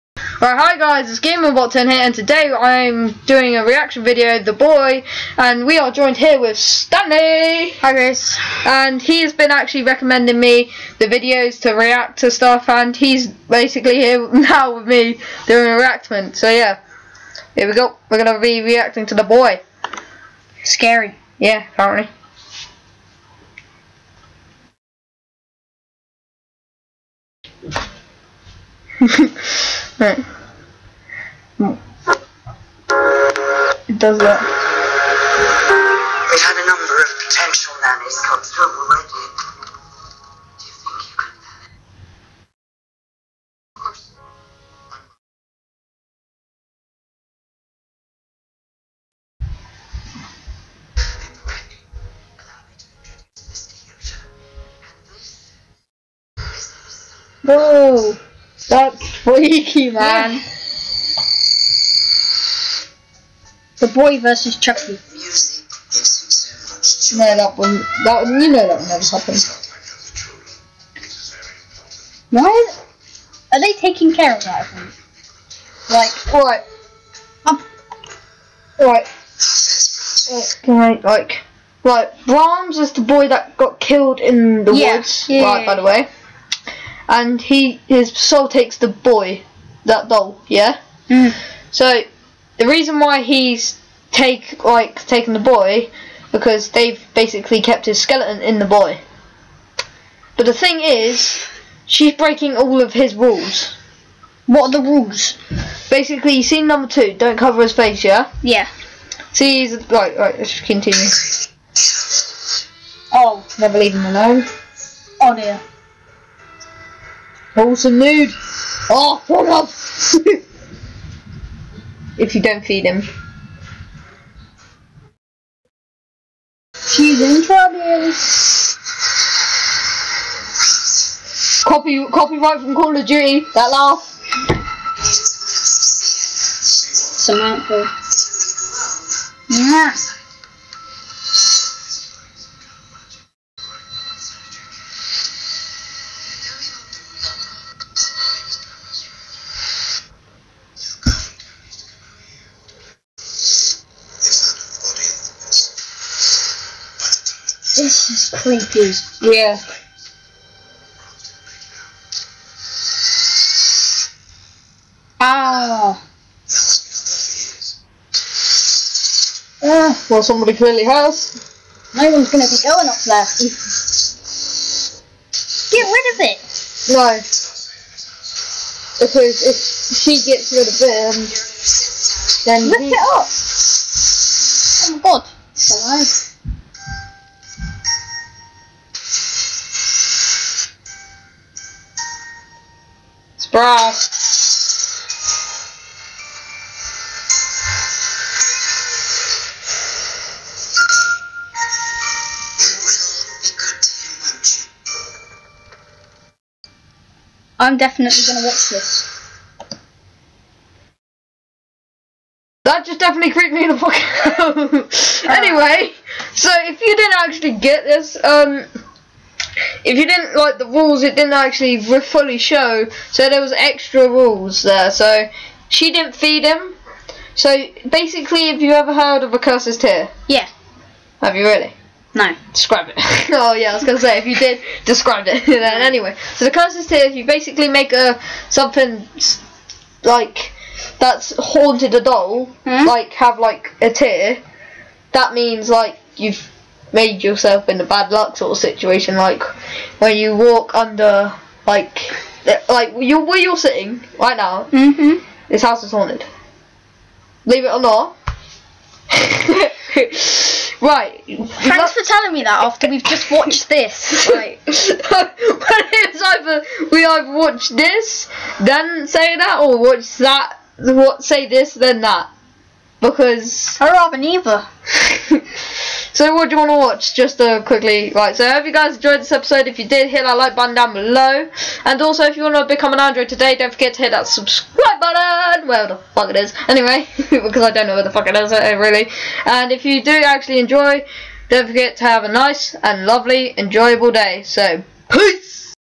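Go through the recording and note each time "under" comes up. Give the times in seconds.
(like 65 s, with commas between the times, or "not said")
250 s.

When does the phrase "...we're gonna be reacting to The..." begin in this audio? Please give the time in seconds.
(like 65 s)
18 s.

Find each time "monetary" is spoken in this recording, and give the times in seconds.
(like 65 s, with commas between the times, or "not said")
not said.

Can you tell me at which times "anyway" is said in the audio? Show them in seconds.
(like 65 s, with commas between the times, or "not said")
215 s, 235 s, 286 s.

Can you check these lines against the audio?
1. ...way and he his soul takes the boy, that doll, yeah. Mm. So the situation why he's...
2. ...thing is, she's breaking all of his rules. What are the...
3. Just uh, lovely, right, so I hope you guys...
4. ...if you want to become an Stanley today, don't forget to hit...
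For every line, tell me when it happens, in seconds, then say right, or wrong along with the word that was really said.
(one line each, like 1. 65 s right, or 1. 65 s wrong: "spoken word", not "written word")
1. 85 s wrong: "reason", not "situation"
2. 100 s right
3. 277 s wrong: "quickly", not "lovely"
4. 282 s wrong: "Android", not "Stanley".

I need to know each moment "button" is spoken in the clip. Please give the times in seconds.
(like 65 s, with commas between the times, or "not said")
280 s, 284 s.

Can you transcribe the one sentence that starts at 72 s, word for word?
Why are they taking care of that?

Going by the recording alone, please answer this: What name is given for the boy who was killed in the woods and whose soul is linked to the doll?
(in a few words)
Brahms.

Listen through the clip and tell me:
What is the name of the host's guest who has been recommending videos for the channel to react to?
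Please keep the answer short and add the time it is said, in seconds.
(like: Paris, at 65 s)
Stanley, at 6 s.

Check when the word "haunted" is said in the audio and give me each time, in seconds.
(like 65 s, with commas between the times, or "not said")
241 s, 255 s.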